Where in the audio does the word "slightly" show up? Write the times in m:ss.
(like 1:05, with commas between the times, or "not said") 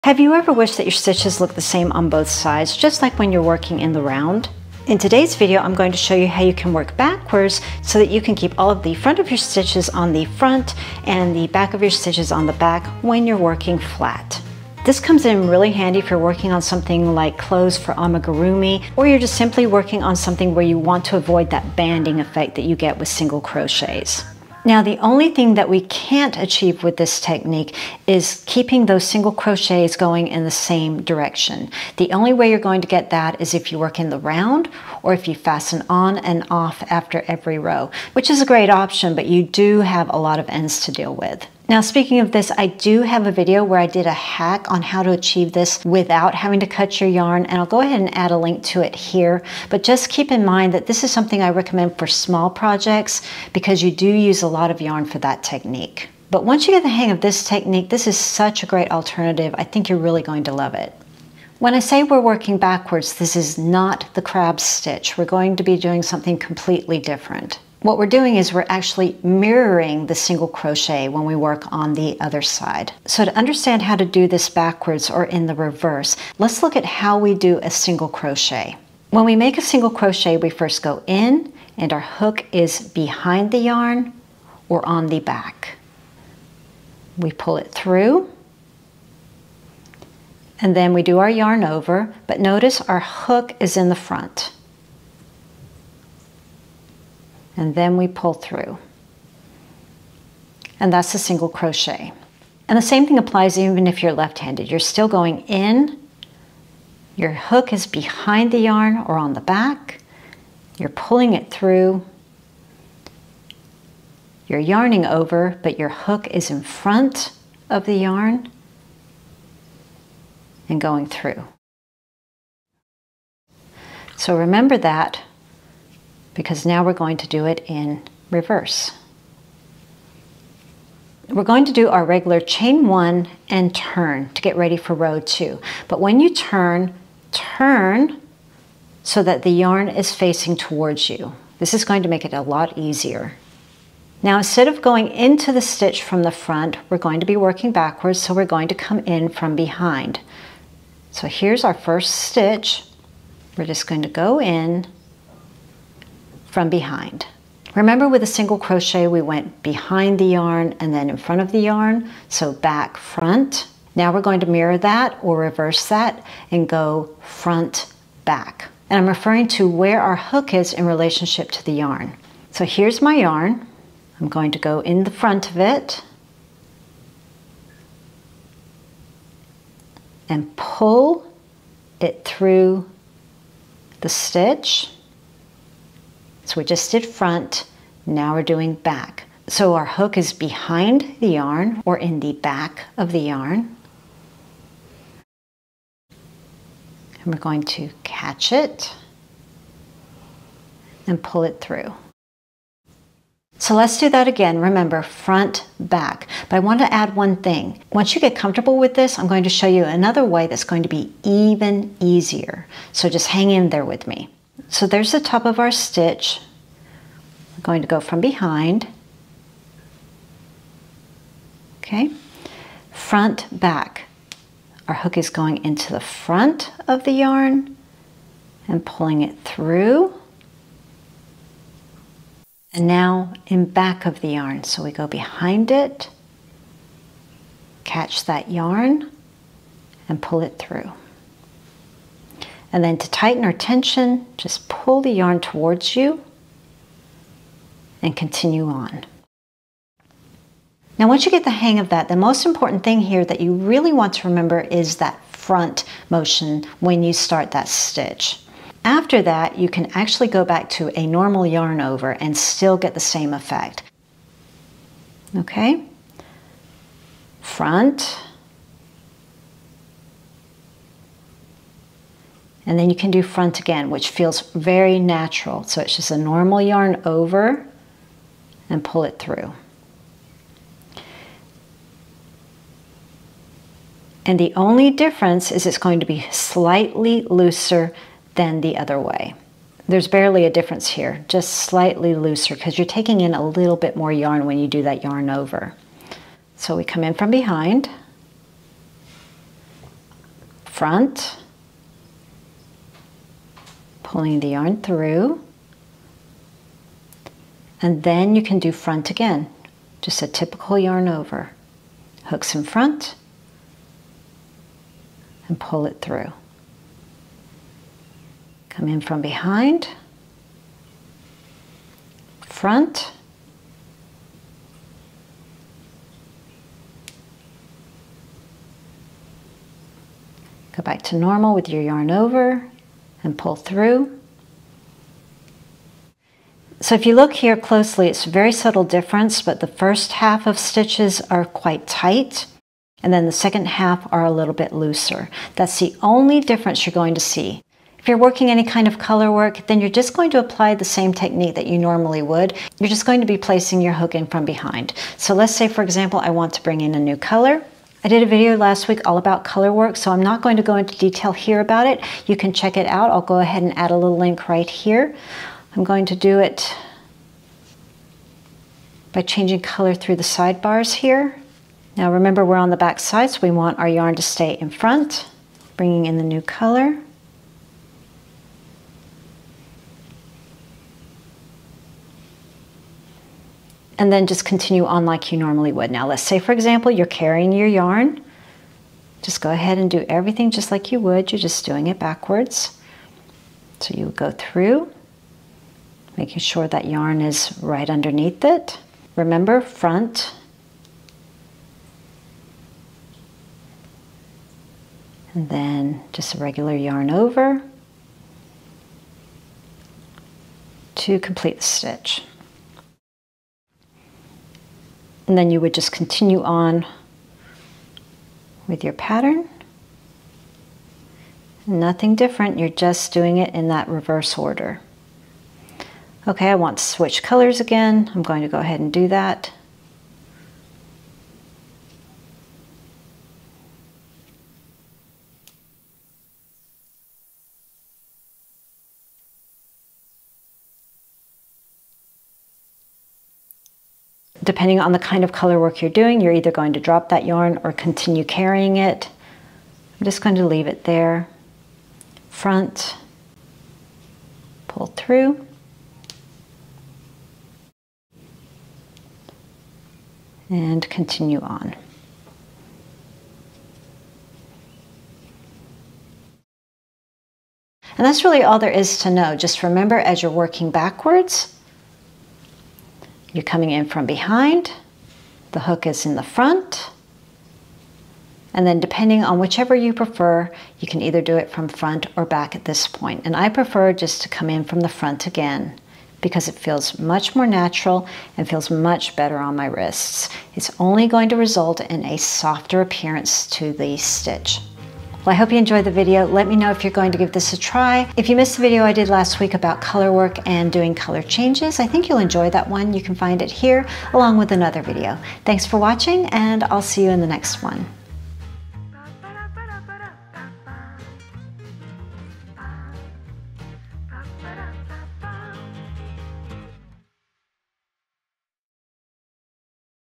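4:46, 4:51.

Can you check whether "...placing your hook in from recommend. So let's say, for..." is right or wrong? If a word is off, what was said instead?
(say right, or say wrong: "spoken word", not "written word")
wrong: "behind", not "recommend".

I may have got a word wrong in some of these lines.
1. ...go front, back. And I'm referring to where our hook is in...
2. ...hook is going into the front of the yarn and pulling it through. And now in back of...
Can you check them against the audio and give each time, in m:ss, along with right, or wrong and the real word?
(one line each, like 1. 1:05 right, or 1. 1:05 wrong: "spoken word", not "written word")
1. 2:46 right
2. 3:44 right.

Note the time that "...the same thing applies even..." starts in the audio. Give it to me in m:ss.
1:42.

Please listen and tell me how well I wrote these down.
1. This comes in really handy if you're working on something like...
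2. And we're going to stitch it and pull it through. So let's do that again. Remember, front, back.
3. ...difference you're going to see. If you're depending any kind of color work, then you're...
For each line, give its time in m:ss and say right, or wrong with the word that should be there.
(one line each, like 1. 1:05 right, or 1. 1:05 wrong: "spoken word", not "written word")
1. 0:14 right
2. 3:17 wrong: "catch", not "stitch"
3. 5:46 wrong: "working", not "depending".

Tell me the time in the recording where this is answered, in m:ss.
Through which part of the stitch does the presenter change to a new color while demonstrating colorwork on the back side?
6:10.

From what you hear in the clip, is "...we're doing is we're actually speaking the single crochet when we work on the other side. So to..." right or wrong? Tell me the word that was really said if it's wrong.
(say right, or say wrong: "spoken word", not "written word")
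wrong: "mirroring", not "speaking".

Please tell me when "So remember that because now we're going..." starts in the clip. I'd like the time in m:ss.
2:04.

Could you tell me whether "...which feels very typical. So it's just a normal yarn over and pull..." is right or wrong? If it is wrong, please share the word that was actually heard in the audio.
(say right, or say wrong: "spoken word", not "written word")
wrong: "natural", not "typical".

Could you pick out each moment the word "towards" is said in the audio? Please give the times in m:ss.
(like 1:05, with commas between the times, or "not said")
2:20, 4:05.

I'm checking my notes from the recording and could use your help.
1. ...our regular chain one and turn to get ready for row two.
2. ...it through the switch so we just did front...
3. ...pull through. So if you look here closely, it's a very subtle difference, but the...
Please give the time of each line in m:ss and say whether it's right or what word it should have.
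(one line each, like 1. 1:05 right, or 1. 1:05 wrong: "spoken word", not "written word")
1. 2:11 right
2. 3:02 wrong: "stitch", not "switch"
3. 5:33 right.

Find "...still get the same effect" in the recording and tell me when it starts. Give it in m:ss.
4:22.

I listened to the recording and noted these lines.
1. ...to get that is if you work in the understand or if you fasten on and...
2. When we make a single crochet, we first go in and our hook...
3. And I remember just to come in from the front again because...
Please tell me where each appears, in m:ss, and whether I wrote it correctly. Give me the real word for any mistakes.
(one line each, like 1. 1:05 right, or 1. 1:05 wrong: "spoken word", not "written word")
1. 0:32 wrong: "round", not "understand"
2. 1:19 right
3. 8:03 wrong: "prefer", not "remember".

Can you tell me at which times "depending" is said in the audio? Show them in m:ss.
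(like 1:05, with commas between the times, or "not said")
7:24, 7:58.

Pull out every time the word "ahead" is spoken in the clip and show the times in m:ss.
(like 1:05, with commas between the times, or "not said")
0:47, 6:03, 6:29, 7:08.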